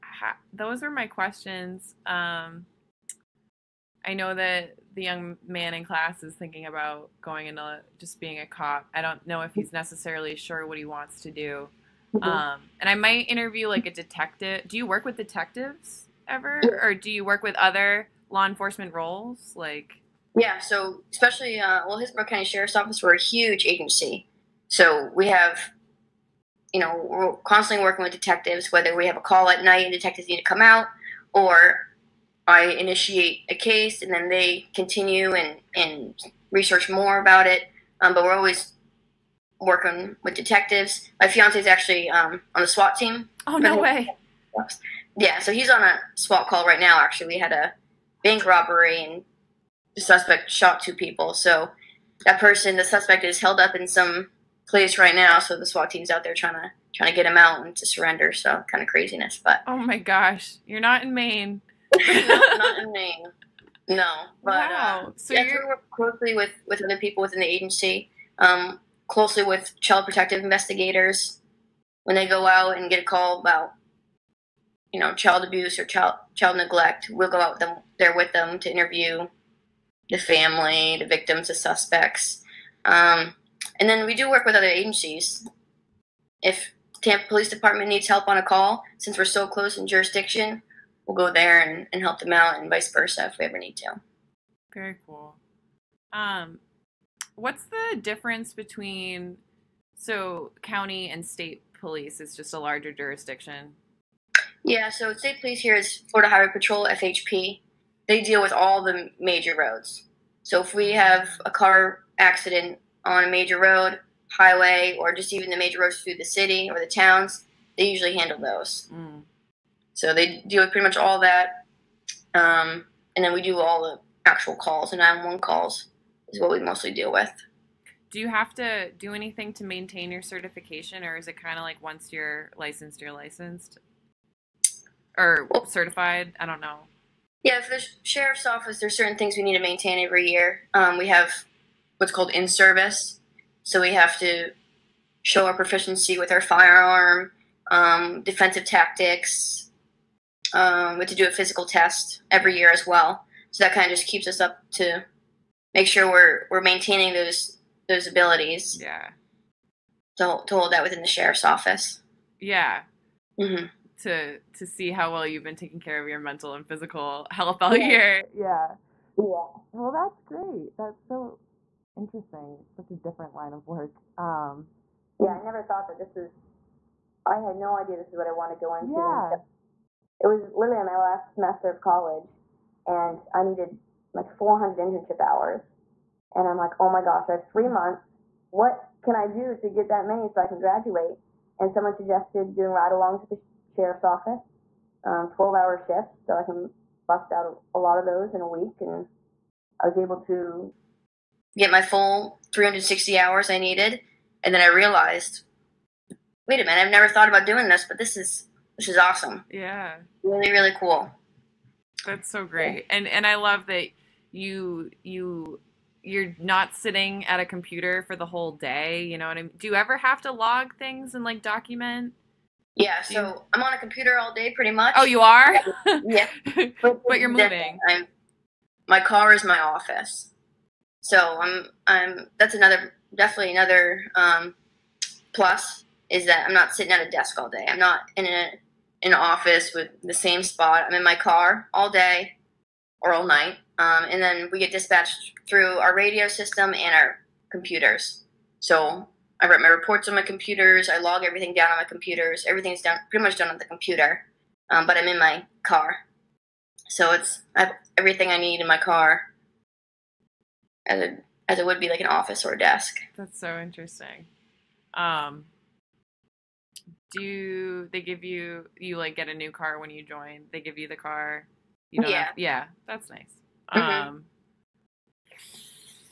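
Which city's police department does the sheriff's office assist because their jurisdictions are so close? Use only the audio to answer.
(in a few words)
Tampa.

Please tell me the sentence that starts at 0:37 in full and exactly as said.
Um, but we're always working with detectives.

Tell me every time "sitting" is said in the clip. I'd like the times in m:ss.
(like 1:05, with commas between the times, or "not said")
3:36, 3:56.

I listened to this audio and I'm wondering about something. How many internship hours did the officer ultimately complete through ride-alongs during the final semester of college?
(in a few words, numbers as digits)
360.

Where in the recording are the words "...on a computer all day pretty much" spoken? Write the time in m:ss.
3:43.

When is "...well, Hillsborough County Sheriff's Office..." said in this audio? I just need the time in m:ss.
0:21.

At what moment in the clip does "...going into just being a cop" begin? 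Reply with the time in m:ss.
0:07.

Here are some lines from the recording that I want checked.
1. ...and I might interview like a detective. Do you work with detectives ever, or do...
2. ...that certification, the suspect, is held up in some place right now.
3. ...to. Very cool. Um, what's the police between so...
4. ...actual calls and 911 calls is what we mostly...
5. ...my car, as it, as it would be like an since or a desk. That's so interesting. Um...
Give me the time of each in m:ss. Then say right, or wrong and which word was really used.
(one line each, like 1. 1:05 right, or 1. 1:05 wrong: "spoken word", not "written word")
1. 0:12 right
2. 0:52 wrong: "person", not "certification"
3. 1:33 wrong: "difference", not "police"
4. 2:04 right
5. 4:18 wrong: "office", not "since".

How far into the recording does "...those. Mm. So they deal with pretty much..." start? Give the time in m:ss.
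1:58.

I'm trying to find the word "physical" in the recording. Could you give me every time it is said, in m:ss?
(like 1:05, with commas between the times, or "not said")
2:31, 2:46.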